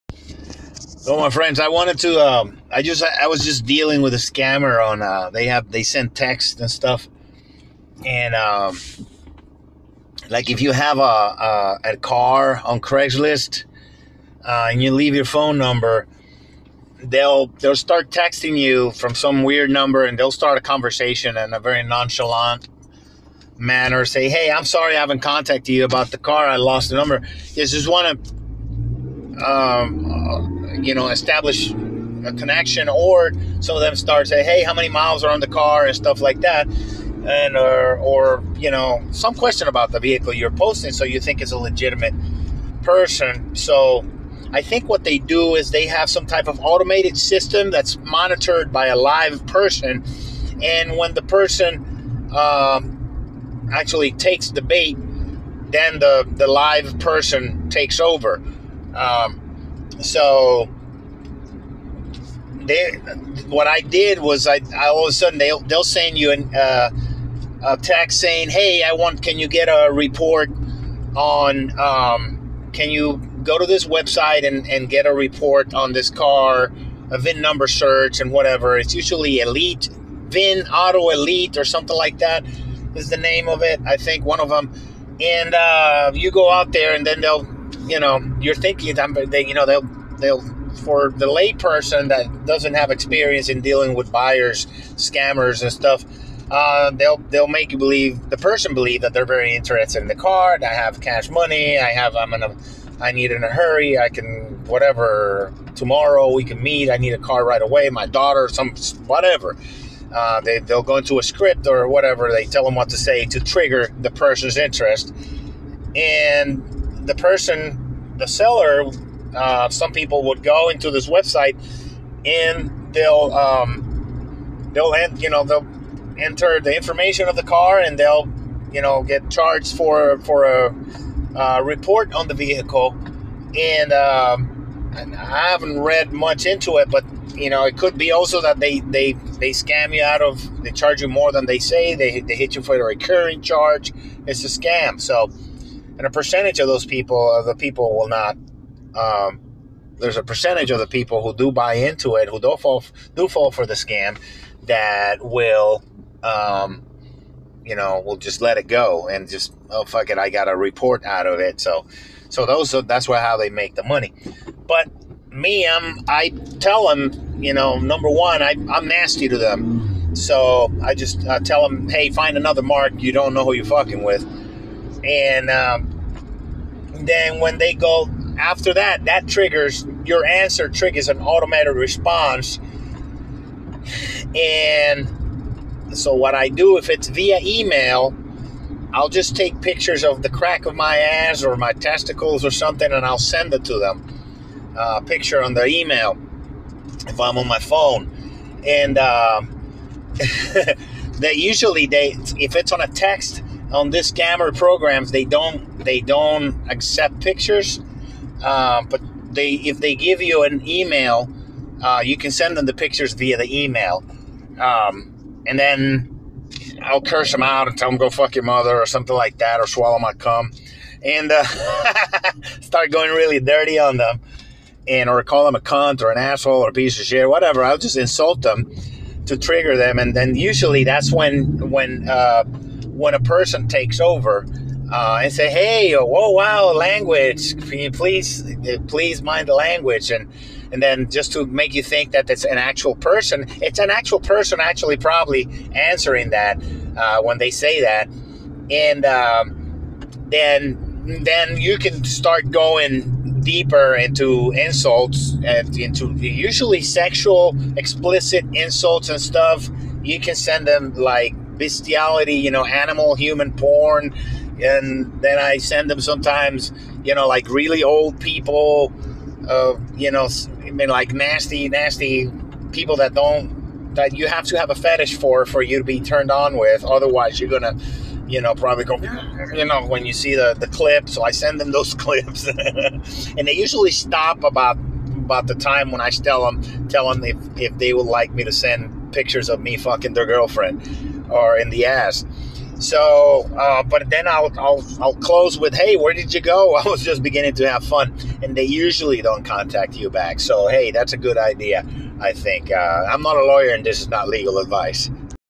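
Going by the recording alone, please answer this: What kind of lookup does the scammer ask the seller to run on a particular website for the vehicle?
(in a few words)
VIN number search.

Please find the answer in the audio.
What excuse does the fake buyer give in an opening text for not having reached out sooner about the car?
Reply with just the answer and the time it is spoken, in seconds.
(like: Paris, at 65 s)
lost the number, at 26 s.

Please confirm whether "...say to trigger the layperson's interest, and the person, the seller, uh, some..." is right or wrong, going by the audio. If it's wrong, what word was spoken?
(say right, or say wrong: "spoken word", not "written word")
wrong: "person", not "layperson".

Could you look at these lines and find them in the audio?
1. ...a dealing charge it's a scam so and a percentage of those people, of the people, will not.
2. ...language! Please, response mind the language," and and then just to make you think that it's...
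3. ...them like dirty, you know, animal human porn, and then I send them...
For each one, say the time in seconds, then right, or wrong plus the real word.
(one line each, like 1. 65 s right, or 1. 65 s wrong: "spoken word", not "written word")
1. 142 s wrong: "recurring", not "dealing"
2. 236 s wrong: "please", not "response"
3. 260 s wrong: "bestiality", not "dirty".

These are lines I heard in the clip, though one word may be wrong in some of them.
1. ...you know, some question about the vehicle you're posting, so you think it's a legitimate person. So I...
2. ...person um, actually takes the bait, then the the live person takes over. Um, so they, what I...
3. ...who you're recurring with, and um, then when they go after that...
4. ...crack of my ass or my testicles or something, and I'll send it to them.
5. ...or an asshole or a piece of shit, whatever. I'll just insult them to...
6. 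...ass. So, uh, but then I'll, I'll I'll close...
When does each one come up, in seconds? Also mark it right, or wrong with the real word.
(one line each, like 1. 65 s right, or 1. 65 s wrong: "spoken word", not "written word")
1. 38 s right
2. 51 s right
3. 173 s wrong: "fucking", not "recurring"
4. 190 s right
5. 226 s right
6. 291 s right.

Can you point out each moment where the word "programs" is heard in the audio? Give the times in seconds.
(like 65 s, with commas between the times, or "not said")
204 s.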